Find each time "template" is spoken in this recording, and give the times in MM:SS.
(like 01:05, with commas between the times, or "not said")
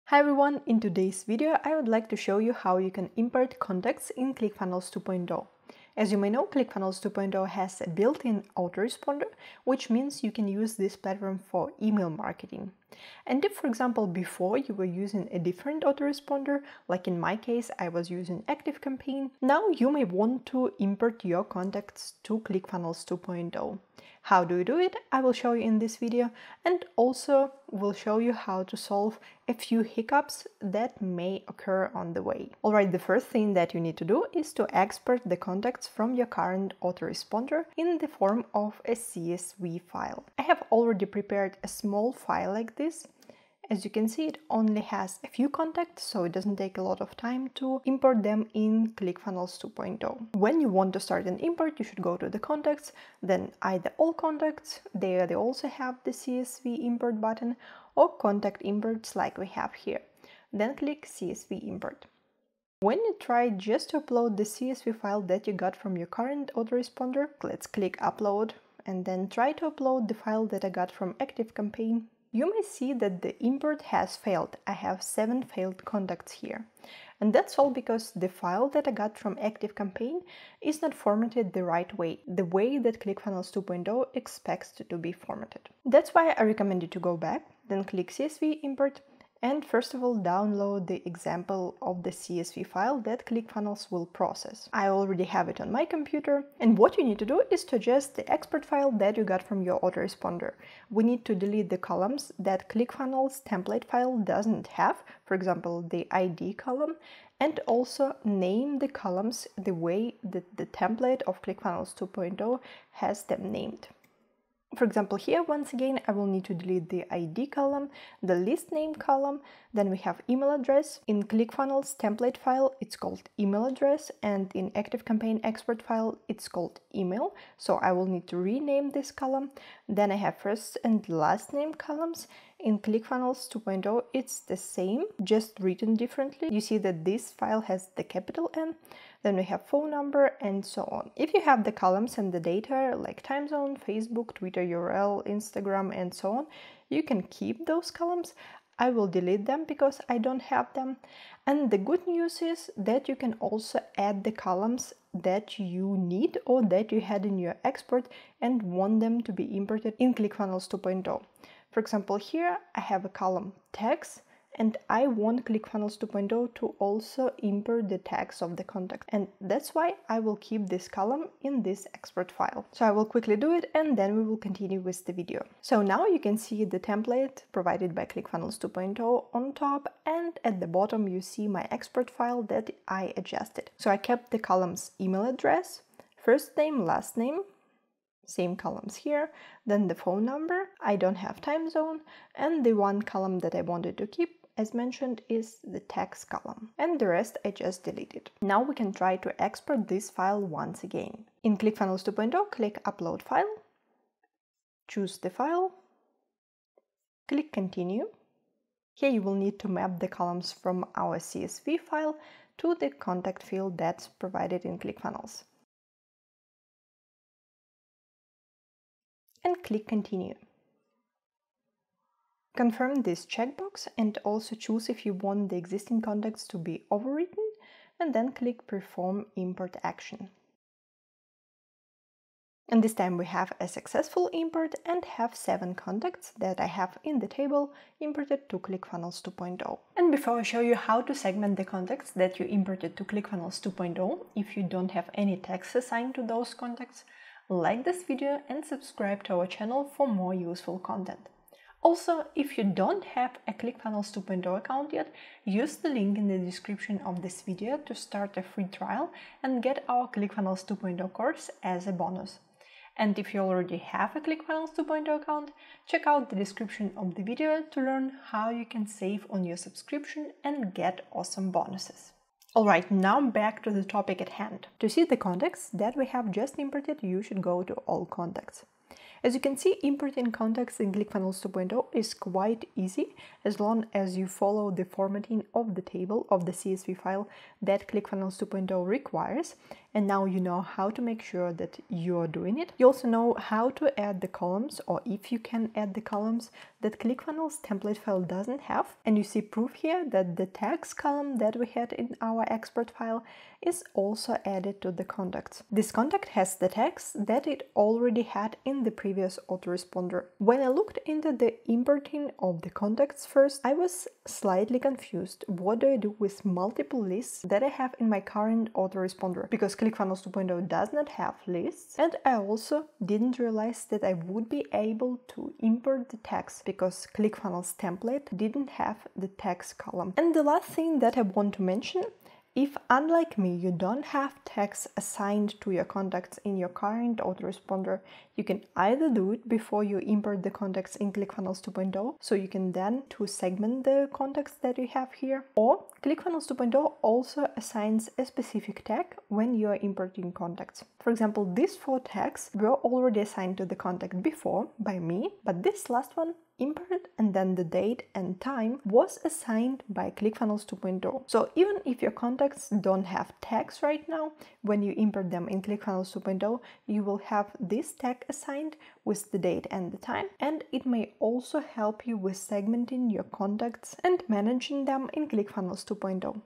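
01:43, 01:50, 02:01, 02:56, 04:57, 05:27.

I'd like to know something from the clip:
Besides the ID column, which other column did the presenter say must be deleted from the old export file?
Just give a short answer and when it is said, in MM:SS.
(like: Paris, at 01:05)
list name, at 01:58.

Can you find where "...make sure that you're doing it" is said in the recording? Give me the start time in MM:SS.
04:51.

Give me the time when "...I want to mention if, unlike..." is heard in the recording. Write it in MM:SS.
05:31.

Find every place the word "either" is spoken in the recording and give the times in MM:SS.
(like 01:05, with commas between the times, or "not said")
00:53, 05:38.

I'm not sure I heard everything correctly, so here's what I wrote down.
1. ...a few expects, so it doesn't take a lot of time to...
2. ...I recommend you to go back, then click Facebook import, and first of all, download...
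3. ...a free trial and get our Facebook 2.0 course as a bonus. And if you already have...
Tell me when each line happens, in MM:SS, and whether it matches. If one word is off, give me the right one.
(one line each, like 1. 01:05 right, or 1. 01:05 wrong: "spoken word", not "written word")
1. 00:45 wrong: "contacts", not "expects"
2. 01:26 wrong: "CSV", not "Facebook"
3. 04:18 wrong: "ClickFunnels", not "Facebook".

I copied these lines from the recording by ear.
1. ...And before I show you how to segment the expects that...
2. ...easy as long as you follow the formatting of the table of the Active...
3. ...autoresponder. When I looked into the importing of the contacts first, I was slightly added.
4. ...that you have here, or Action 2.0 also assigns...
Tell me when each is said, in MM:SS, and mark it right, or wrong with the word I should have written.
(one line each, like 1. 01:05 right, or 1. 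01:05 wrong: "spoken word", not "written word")
1. 03:59 wrong: "contacts", not "expects"
2. 04:42 wrong: "CSV", not "Active"
3. 05:09 wrong: "confused", not "added"
4. 05:44 wrong: "ClickFunnels", not "Action".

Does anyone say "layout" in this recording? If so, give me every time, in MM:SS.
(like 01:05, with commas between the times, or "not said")
not said.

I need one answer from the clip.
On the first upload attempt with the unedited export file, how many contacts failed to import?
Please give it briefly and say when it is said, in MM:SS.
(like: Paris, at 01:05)
7, at 01:15.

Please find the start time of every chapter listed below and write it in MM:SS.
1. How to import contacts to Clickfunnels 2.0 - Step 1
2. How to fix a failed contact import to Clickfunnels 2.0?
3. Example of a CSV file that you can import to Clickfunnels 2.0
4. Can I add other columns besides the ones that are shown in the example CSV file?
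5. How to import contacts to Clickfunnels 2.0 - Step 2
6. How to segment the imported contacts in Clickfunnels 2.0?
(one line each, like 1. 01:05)
1. 00:32
2. 01:02
3. 01:25
4. 02:31
5. 03:21
6. 04:00.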